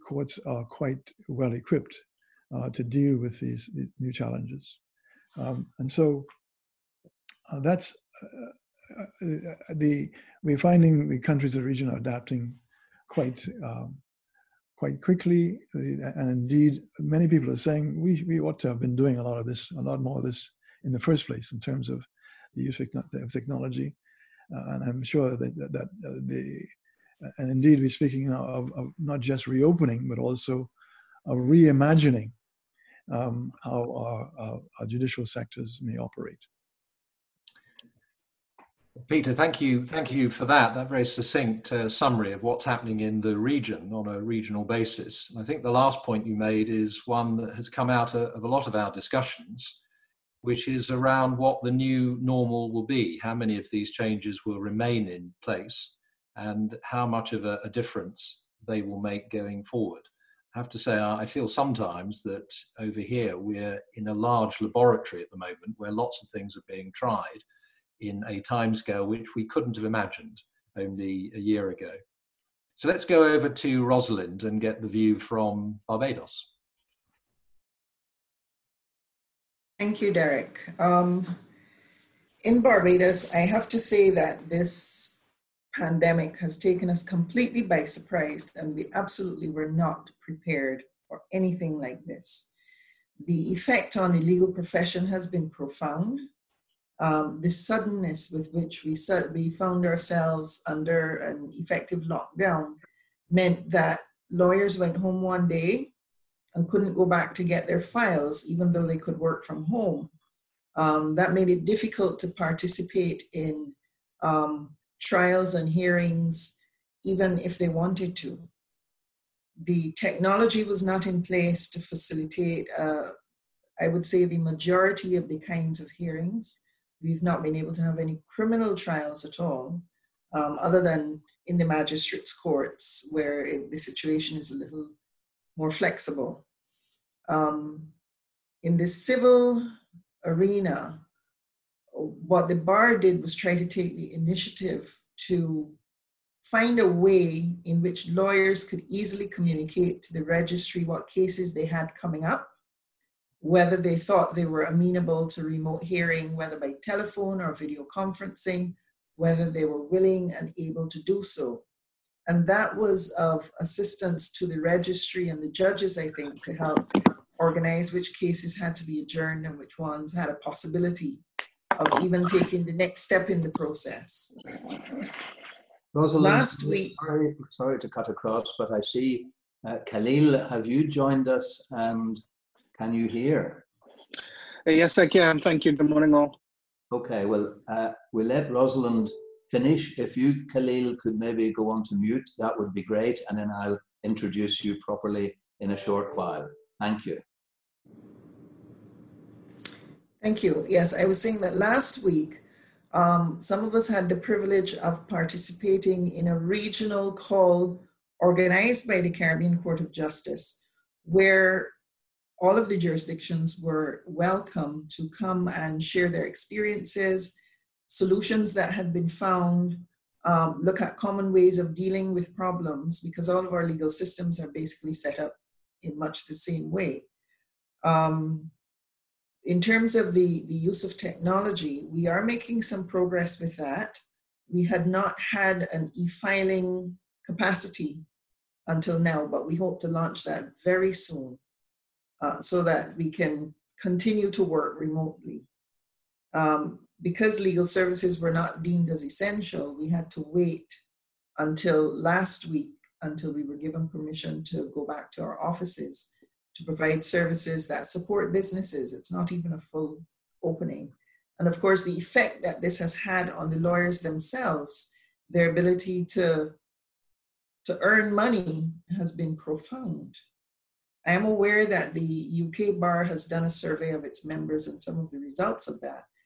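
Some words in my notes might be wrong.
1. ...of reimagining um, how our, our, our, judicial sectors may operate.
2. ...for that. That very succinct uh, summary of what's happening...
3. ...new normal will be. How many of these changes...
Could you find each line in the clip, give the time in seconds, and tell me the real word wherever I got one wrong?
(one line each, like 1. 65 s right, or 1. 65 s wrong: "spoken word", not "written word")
1. 31 s right
2. 40 s right
3. 51 s right.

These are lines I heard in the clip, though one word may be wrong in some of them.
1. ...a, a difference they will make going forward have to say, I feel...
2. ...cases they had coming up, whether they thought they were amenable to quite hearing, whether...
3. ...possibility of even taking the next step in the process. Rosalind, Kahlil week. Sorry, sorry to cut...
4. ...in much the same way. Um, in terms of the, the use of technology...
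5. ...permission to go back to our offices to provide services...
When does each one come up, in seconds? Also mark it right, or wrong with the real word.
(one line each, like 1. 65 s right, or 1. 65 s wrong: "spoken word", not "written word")
1. 57 s right
2. 151 s wrong: "remote", not "quite"
3. 170 s wrong: "Last", not "Kahlil"
4. 225 s right
5. 253 s right.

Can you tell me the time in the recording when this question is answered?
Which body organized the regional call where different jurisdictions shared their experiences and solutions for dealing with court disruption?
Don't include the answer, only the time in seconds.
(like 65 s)
209 s.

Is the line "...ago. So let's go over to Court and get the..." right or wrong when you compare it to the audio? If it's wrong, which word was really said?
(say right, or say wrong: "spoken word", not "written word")
wrong: "Rosalind", not "Court".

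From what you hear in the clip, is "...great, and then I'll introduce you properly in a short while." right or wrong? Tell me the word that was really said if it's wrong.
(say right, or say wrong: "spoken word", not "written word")
right.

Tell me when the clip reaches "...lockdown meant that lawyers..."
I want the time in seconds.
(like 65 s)
102 s.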